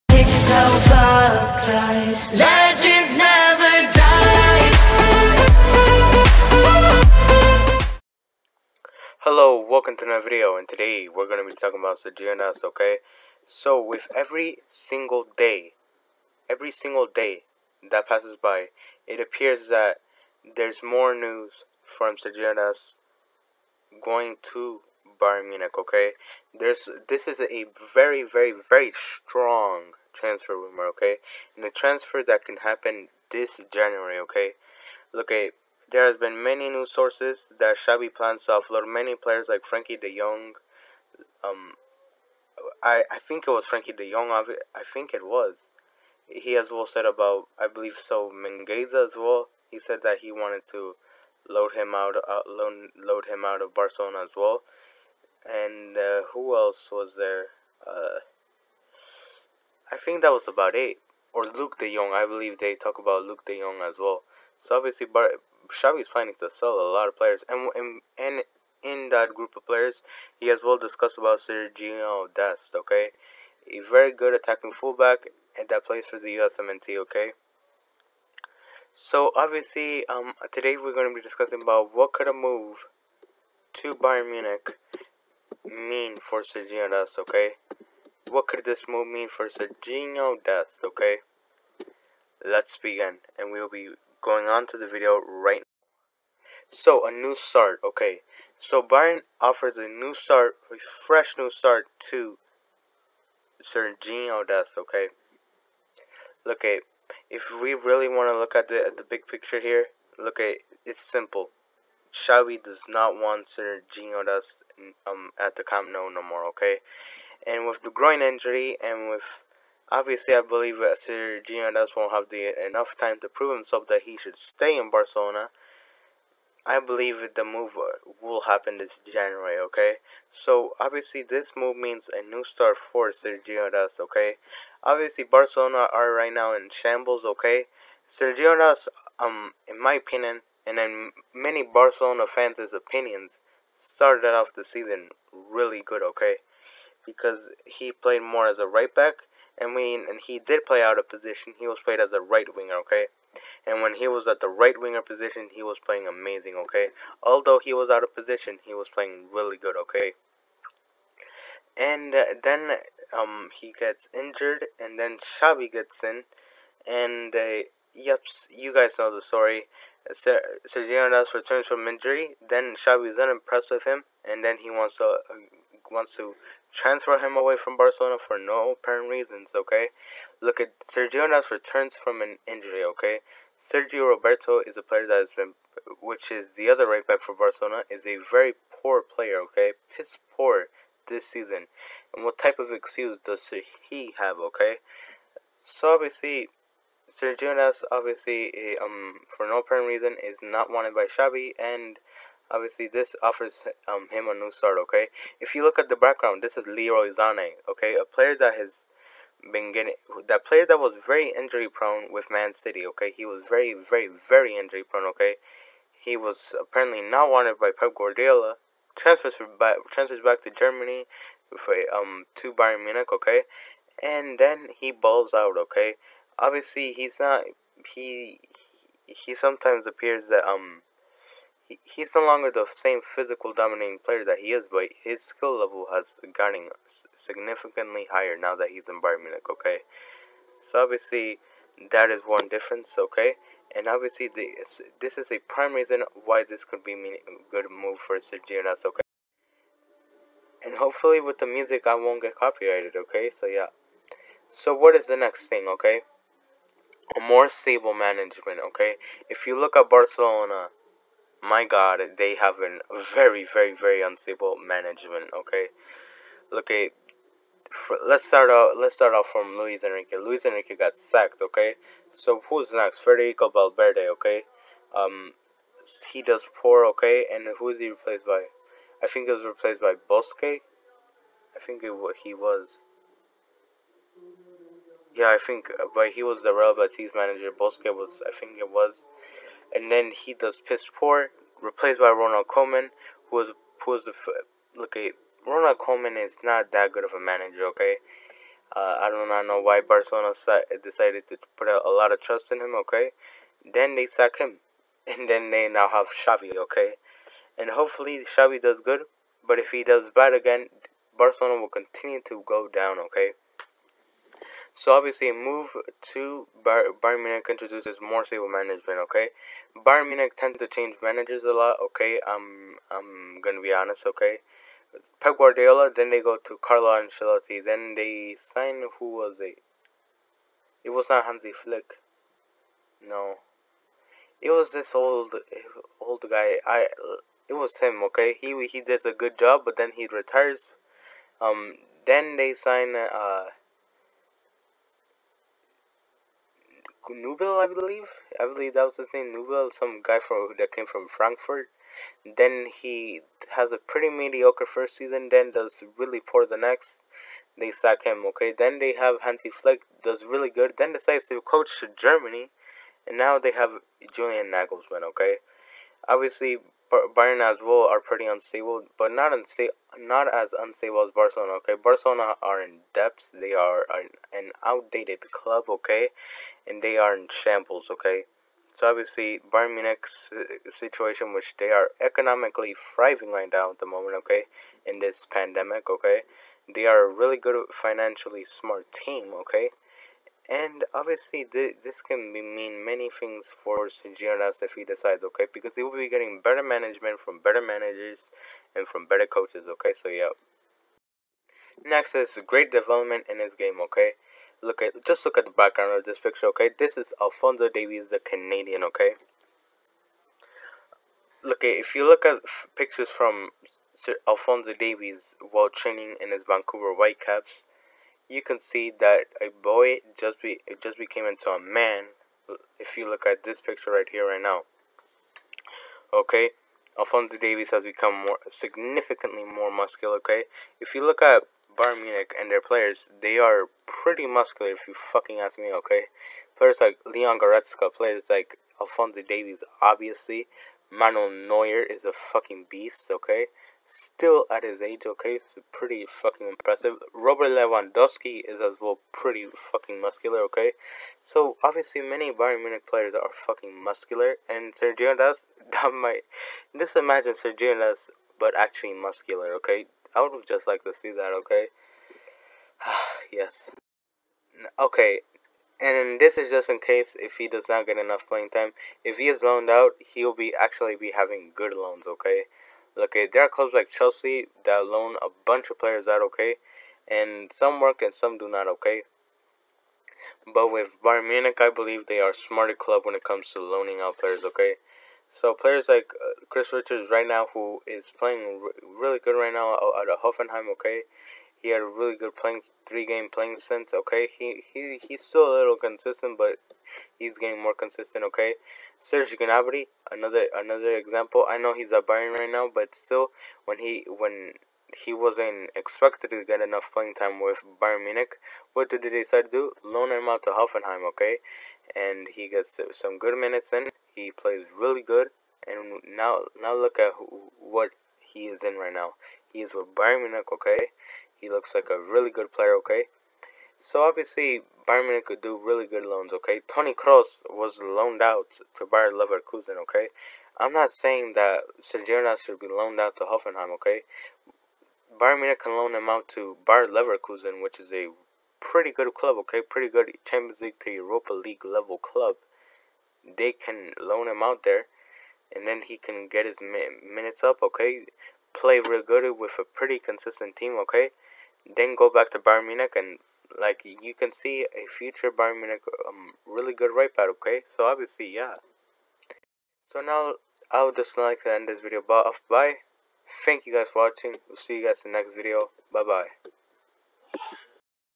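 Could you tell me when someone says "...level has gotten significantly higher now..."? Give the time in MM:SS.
03:55.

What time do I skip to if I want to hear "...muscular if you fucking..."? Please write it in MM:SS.
07:14.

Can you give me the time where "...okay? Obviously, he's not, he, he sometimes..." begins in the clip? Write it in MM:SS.
03:45.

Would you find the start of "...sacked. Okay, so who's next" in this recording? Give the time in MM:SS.
04:30.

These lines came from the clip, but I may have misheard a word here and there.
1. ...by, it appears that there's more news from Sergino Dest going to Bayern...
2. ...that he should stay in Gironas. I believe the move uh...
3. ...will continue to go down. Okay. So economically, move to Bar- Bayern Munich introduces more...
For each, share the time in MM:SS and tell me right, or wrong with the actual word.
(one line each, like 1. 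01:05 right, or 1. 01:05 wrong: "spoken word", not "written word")
1. 00:18 right
2. 02:03 wrong: "Barcelona", not "Gironas"
3. 05:11 wrong: "obviously", not "economically".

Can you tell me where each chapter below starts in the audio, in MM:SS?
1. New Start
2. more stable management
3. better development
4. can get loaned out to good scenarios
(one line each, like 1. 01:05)
1. 01:36
2. 04:09
3. 06:41
4. 07:44.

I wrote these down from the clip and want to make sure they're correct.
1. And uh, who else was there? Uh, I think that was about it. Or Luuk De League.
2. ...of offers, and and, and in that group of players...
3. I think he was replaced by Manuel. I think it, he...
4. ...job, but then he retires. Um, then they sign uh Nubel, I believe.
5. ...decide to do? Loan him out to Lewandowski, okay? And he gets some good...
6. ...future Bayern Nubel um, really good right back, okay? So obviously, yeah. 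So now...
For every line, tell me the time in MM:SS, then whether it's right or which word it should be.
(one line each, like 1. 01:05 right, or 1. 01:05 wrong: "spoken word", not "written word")
1. 00:55 wrong: "Jong", not "League"
2. 01:07 wrong: "players", not "offers"
3. 04:39 wrong: "Bosque", not "Manuel"
4. 05:39 right
5. 08:29 wrong: "Hoffenheim", not "Lewandowski"
6. 09:14 wrong: "Munich", not "Nubel".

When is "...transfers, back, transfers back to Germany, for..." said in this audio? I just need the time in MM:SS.
03:38.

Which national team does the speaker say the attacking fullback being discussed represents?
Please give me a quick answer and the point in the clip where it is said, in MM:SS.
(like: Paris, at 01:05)
USMNT, at 01:16.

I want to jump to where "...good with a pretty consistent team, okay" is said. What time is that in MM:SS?
09:09.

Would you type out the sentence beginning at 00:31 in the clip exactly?
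And a transfer that can happen this January, okay?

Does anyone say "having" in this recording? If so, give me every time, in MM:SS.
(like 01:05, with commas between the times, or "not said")
07:51.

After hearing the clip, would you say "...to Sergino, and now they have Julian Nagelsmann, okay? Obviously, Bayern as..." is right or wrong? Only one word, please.
wrong.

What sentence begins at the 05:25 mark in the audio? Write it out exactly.
Then they go to Carlo Ancelotti.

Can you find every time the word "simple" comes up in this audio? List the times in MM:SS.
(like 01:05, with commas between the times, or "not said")
01:51.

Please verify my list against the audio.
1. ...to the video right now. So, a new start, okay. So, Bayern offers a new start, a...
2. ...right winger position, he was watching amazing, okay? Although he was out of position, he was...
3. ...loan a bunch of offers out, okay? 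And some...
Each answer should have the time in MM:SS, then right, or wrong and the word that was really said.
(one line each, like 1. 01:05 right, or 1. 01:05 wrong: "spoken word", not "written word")
1. 01:34 right
2. 02:34 wrong: "playing", not "watching"
3. 07:54 wrong: "players", not "offers".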